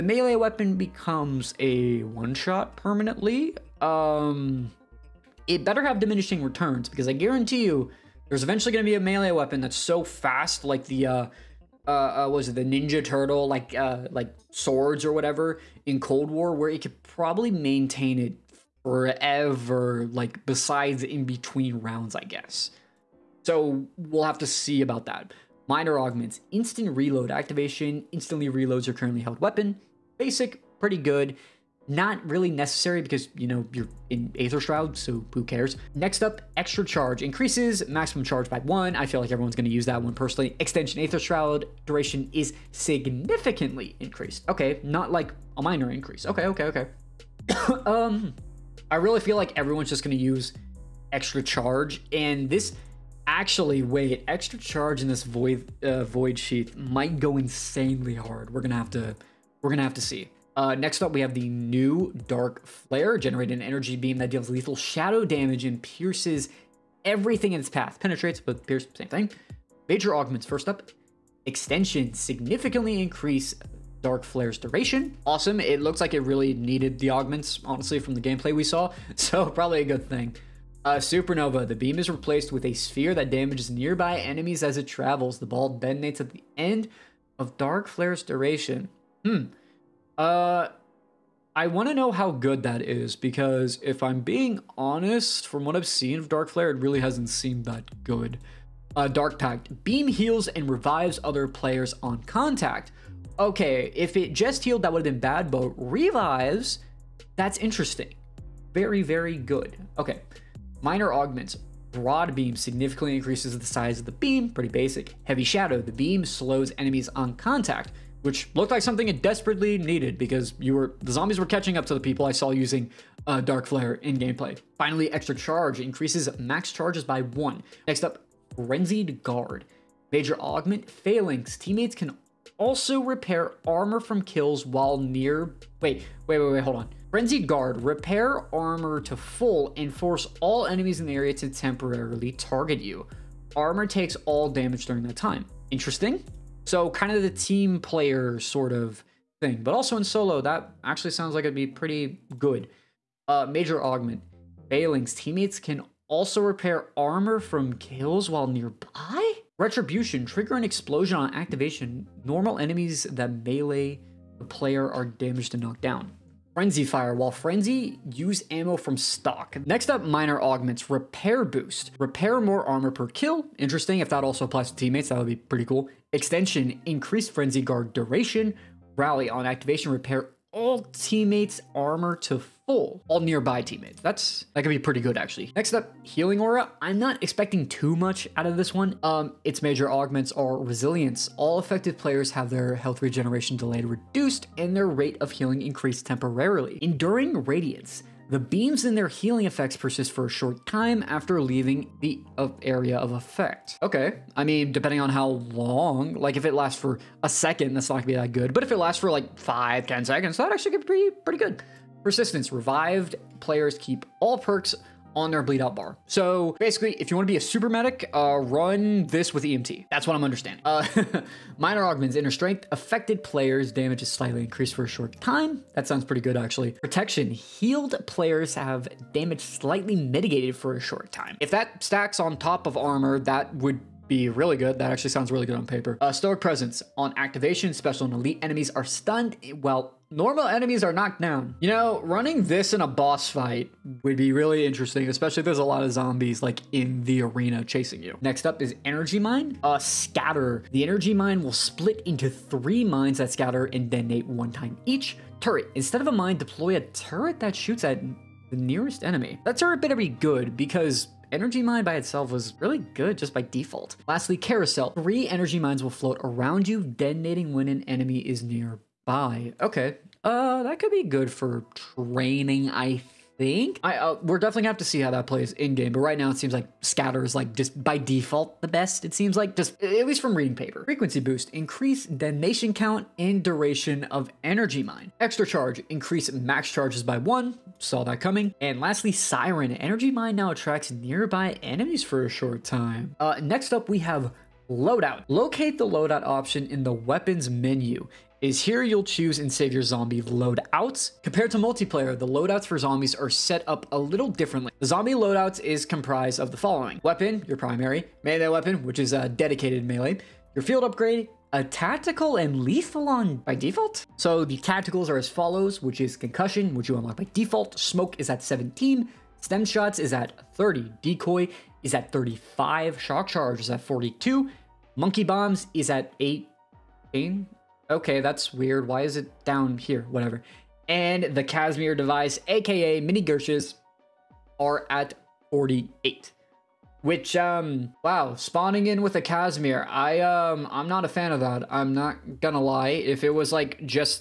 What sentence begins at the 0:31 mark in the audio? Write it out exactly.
Not really necessary because, you know, you're in Aether Shroud, so who cares?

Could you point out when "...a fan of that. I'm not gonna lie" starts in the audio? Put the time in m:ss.
5:41.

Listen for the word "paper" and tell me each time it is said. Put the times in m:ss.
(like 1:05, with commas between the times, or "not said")
3:55, 4:40.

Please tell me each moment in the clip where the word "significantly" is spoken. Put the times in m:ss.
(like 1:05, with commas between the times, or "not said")
0:42, 1:12, 1:52.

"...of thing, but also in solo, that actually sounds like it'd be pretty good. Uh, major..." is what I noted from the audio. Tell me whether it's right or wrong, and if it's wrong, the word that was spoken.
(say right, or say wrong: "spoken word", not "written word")
right.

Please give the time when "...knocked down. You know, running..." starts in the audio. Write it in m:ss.
4:00.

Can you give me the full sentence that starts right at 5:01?
Compared to multiplayer, the loadouts for zombies are set up a little differently.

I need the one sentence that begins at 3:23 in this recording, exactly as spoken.
Okay, I mean, depending on how long, like if it lasts for a second, that's not gonna be that good.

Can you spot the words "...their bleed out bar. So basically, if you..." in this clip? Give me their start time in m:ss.
3:35.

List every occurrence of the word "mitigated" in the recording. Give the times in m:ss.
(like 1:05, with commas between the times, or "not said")
3:49.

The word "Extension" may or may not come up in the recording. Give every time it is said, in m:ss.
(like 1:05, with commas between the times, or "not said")
0:40, 1:11, 2:56.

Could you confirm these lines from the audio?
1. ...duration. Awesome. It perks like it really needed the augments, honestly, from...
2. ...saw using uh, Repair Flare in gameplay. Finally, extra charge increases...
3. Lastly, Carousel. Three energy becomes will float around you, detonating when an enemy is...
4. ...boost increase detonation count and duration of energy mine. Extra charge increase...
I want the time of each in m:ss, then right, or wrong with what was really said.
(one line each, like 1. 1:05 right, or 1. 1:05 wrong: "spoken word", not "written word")
1. 1:14 wrong: "looks", not "perks"
2. 2:02 wrong: "Dark", not "Repair"
3. 4:24 wrong: "mines", not "becomes"
4. 4:41 right.